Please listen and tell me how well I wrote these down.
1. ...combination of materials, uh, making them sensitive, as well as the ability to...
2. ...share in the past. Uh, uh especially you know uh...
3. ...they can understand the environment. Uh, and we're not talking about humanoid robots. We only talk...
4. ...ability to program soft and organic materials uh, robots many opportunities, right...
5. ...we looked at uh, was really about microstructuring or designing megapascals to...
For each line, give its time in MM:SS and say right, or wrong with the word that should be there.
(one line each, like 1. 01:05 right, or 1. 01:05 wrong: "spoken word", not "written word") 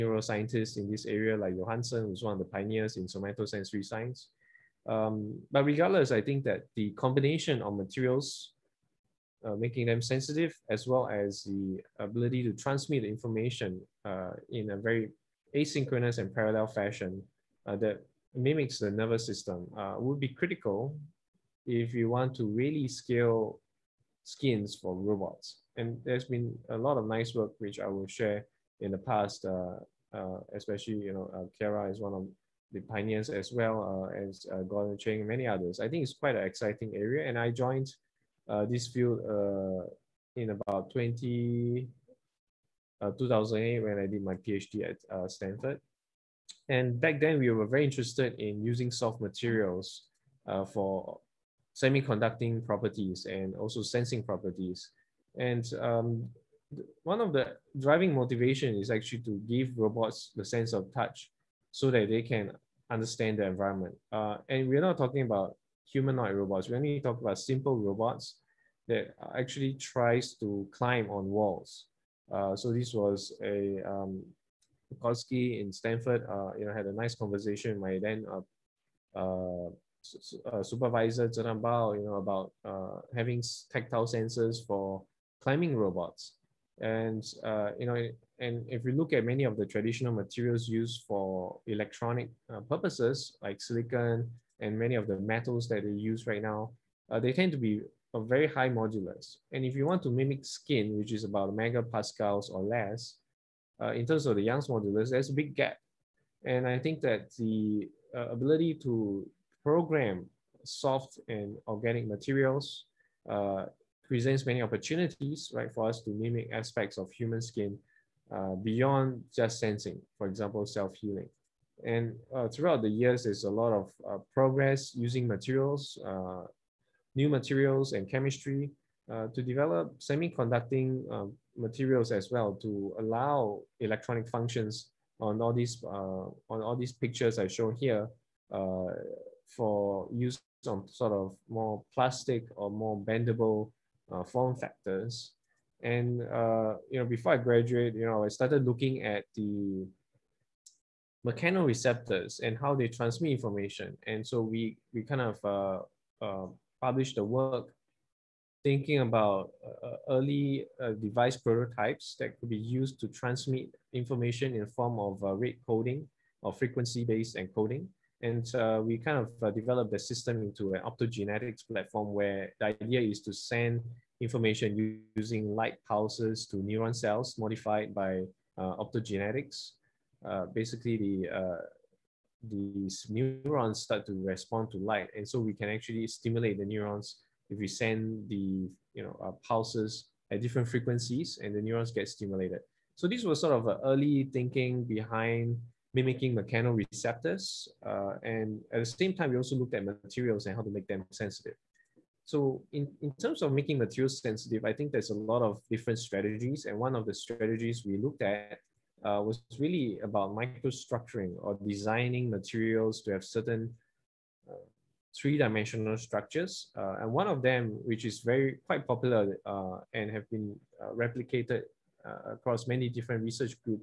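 1. 00:06 right
2. 00:28 right
3. 01:02 right
4. 01:48 wrong: "presents", not "robots"
5. 03:27 wrong: "materials", not "megapascals".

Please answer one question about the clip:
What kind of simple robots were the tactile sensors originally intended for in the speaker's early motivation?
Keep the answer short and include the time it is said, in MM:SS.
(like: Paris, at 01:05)
Climbing robots, at 01:25.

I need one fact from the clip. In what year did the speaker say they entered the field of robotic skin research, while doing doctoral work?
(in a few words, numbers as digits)
2008.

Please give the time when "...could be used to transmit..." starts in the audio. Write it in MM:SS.
02:42.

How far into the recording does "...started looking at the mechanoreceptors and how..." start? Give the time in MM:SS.
02:28.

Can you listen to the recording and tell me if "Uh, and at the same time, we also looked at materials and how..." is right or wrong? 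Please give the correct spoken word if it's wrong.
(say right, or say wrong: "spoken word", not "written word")
right.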